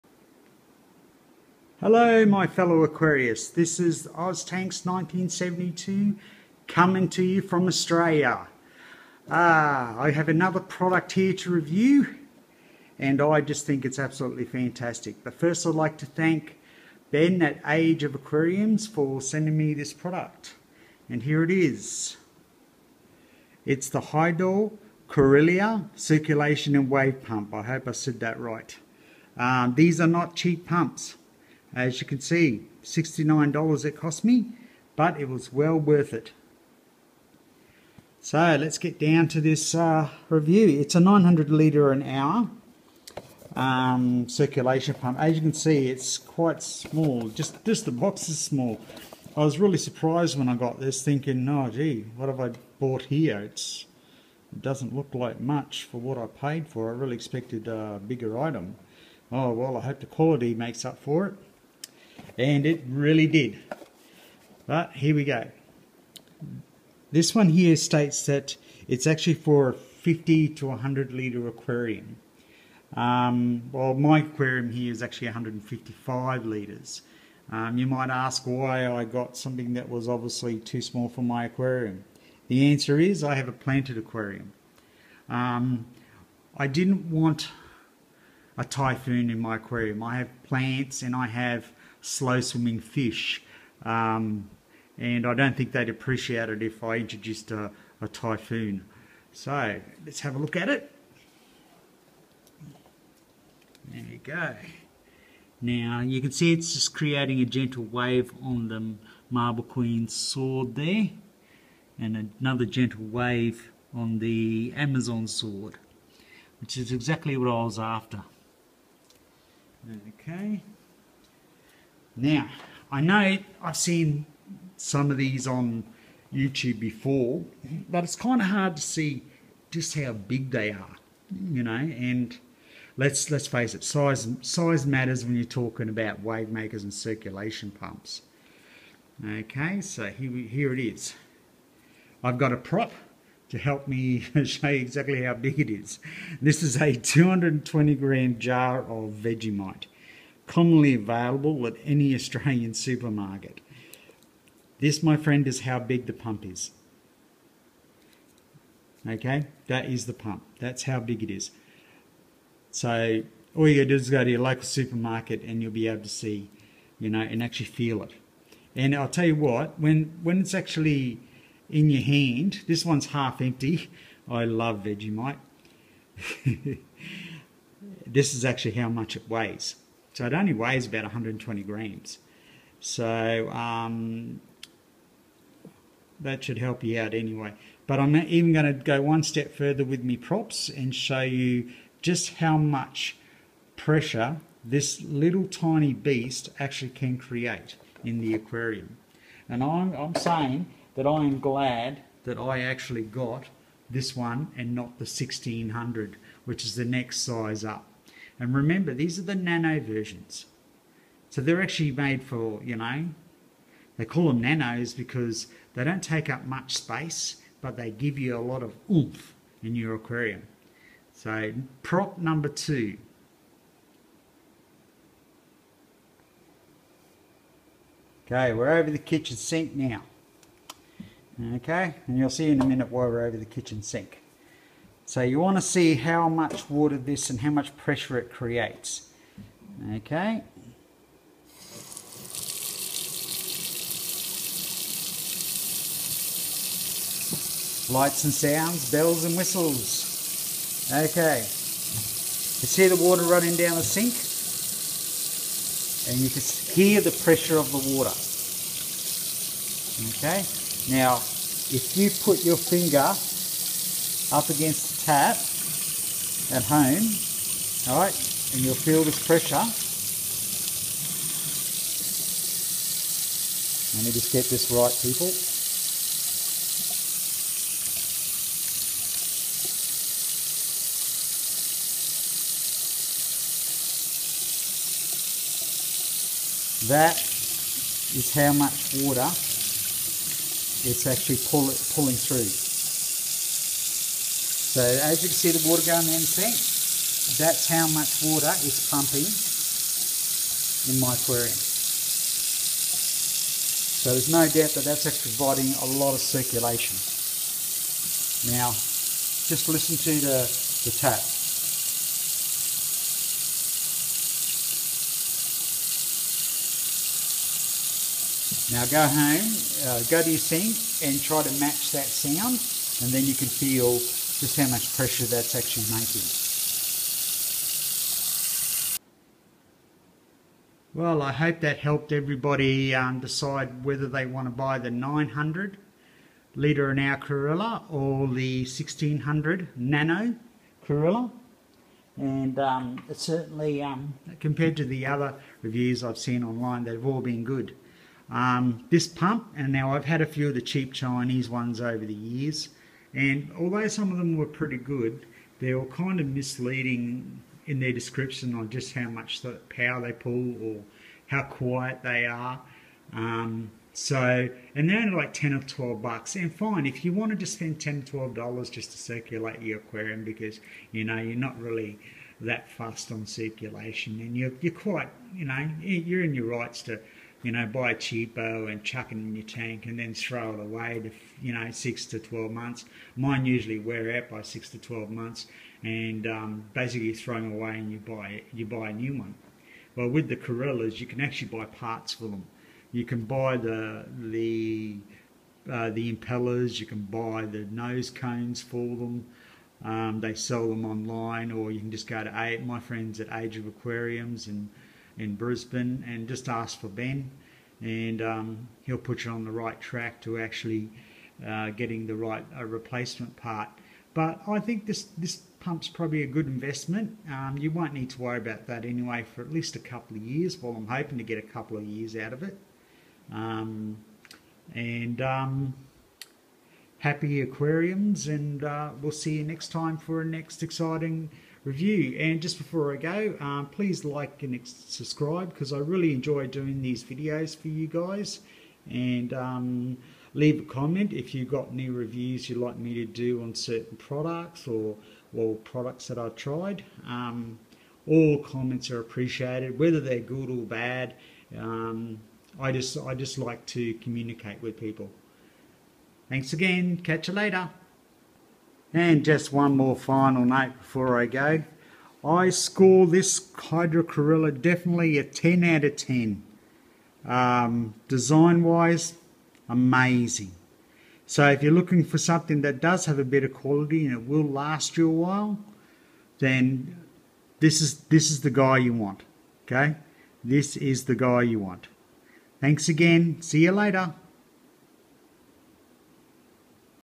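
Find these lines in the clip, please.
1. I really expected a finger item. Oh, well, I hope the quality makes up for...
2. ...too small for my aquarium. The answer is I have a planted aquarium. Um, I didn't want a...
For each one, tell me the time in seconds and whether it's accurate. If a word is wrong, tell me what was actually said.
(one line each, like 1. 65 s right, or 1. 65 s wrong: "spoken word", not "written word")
1. 56 s wrong: "bigger", not "finger"
2. 80 s right.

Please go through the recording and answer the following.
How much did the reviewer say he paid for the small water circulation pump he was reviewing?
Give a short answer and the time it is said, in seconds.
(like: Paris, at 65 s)
$69, at 32 s.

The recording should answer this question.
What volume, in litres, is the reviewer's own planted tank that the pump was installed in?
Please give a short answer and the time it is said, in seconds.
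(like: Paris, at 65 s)
155 litres, at 75 s.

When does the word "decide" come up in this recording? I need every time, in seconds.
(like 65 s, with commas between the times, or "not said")
333 s.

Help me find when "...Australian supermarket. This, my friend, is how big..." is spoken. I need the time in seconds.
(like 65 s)
152 s.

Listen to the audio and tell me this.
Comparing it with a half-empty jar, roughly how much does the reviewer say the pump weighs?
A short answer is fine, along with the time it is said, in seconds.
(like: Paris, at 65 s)
120 grams, at 181 s.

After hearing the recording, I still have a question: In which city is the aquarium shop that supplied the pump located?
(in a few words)
Brisbane.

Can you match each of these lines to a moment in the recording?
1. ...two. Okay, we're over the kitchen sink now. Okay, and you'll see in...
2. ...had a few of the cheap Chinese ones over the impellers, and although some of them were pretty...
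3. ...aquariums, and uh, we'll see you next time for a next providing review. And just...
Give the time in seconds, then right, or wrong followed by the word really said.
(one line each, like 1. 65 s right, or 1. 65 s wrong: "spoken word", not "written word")
1. 222 s right
2. 350 s wrong: "years", not "impellers"
3. 427 s wrong: "exciting", not "providing".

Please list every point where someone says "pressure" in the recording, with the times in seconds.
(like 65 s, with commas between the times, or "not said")
193 s, 237 s, 257 s, 269 s, 324 s.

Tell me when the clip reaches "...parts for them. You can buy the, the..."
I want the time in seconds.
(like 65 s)
391 s.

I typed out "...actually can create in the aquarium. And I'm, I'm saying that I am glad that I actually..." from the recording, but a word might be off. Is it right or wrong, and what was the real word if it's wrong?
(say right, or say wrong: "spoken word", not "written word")
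right.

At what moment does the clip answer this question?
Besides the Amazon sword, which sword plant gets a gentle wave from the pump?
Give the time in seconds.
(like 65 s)
109 s.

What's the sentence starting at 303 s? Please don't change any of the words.
So there's no doubt that that's actually providing a lot of circulation.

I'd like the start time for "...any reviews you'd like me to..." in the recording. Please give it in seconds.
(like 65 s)
441 s.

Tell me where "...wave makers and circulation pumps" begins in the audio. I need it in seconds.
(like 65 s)
136 s.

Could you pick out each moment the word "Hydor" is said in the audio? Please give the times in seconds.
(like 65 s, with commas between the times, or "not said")
24 s, 463 s.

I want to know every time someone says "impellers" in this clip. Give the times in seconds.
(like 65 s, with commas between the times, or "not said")
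396 s.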